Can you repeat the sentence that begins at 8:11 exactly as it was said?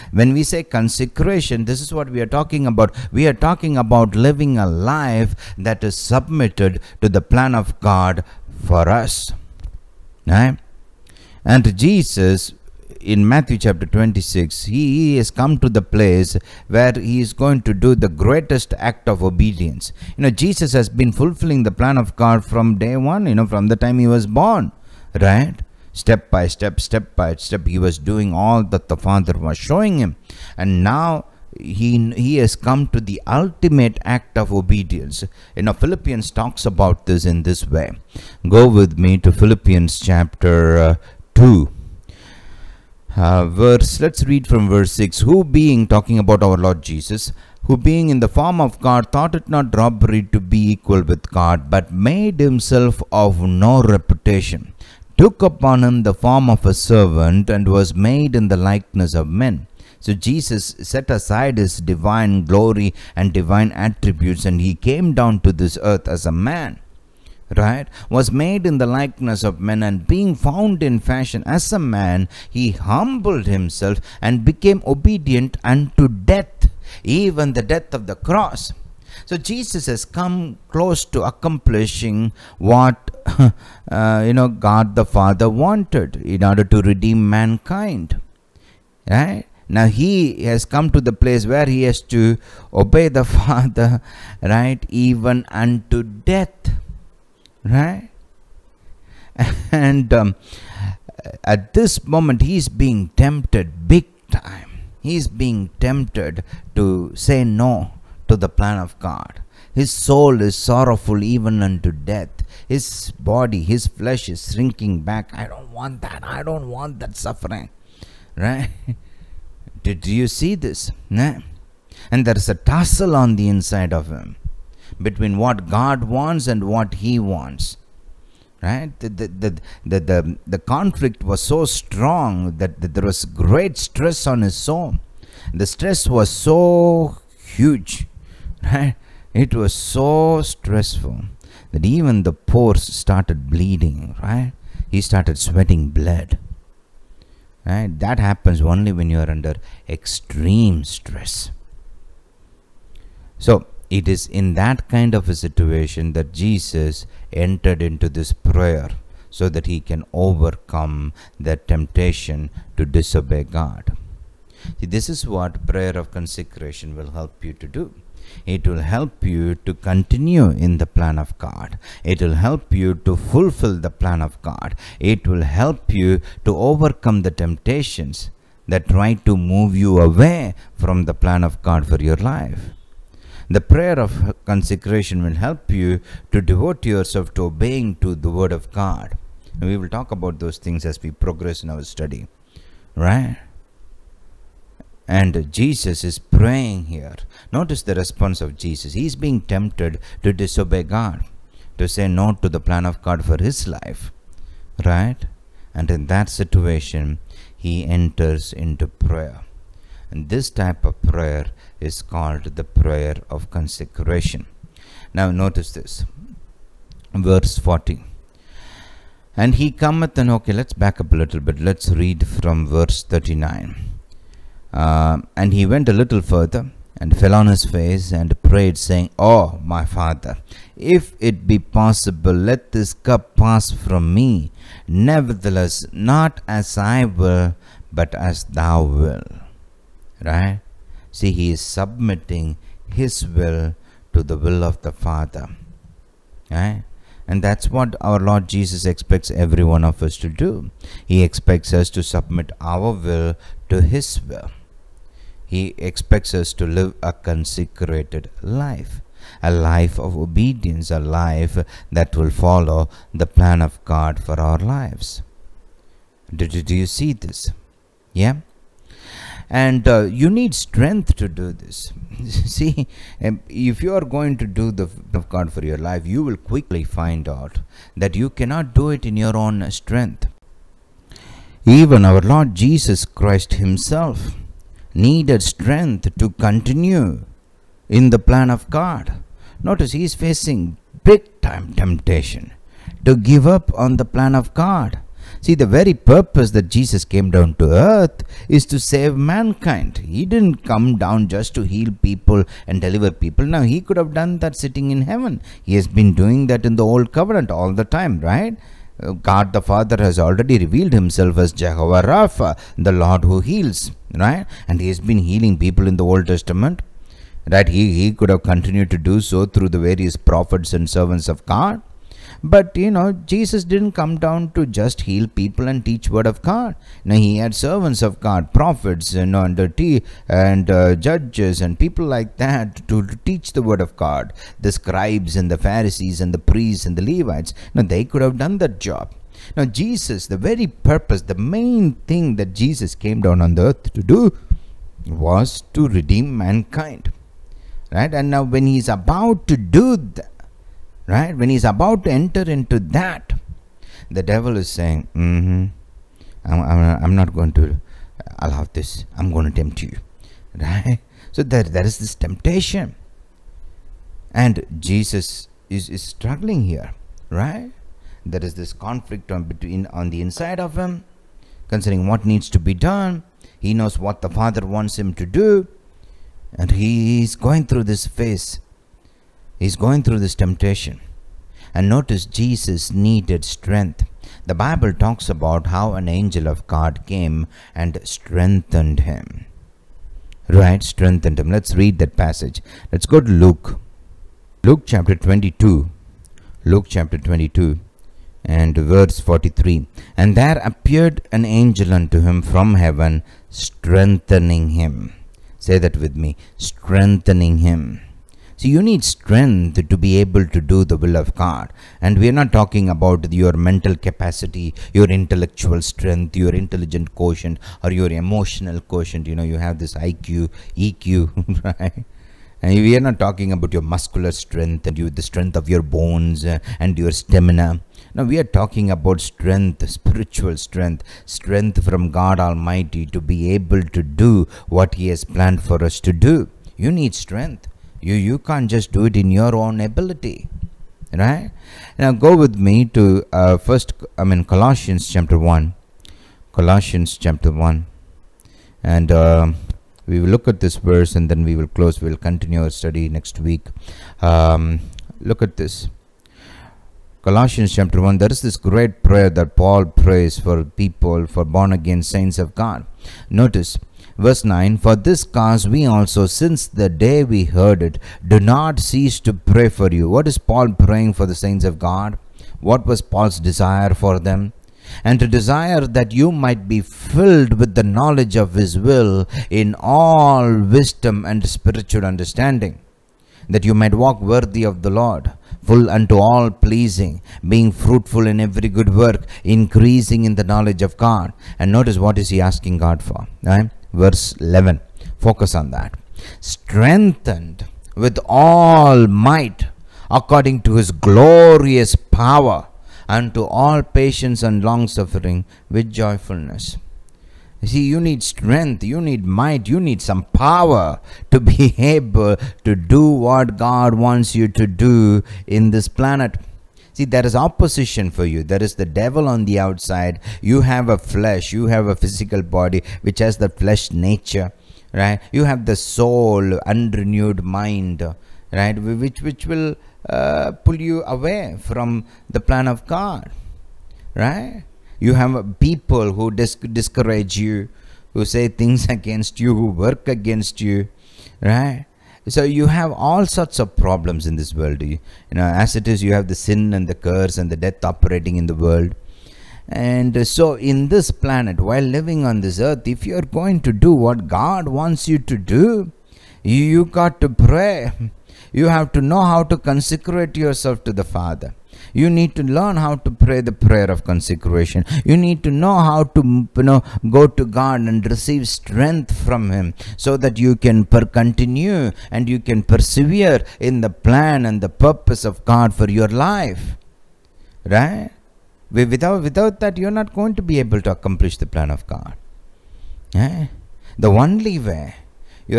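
And notice what is he asking God for, right?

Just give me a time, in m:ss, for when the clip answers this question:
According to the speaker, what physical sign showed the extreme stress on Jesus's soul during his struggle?
2:25.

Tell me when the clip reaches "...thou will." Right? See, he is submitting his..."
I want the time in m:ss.
3:58.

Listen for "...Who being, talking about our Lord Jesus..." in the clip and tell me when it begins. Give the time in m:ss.
0:45.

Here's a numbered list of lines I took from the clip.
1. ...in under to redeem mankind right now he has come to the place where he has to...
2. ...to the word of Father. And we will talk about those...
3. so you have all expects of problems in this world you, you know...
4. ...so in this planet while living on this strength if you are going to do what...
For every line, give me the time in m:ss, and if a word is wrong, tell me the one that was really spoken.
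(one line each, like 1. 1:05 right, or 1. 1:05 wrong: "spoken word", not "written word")
1. 1:26 wrong: "order", not "under"
2. 3:07 wrong: "God", not "Father"
3. 9:02 wrong: "sorts", not "expects"
4. 9:10 wrong: "earth", not "strength".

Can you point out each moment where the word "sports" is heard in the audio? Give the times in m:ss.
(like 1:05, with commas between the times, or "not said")
not said.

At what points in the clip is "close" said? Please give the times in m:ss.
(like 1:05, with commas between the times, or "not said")
1:20, 7:31.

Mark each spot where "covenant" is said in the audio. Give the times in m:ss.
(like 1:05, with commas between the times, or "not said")
5:07.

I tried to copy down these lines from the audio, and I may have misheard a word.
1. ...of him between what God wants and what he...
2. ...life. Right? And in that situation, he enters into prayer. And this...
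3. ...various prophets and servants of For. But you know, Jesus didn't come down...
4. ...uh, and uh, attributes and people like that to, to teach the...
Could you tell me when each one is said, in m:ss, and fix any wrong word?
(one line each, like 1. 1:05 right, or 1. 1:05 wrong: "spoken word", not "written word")
1. 2:03 right
2. 3:23 right
3. 5:19 wrong: "God", not "For"
4. 5:29 wrong: "judges", not "attributes".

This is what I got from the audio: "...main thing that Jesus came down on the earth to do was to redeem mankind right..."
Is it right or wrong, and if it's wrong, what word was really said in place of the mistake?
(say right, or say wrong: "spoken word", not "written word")
right.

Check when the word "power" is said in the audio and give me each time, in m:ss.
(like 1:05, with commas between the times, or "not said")
8:21, 8:30.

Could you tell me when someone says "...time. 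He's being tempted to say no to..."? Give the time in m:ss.
1:44.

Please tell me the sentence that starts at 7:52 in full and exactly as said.
What was Paul's desire for them?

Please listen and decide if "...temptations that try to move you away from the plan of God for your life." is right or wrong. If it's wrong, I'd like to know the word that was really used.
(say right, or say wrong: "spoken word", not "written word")
right.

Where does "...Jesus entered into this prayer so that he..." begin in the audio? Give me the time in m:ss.
2:36.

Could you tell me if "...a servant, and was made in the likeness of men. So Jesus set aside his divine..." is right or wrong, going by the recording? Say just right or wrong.
right.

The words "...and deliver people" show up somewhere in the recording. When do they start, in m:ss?
5:02.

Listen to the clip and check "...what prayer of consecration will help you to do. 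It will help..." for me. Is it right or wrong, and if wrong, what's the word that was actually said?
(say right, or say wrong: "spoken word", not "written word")
right.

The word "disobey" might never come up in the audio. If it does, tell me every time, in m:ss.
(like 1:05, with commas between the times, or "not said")
2:42, 3:20.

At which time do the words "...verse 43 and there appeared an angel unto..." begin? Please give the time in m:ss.
6:38.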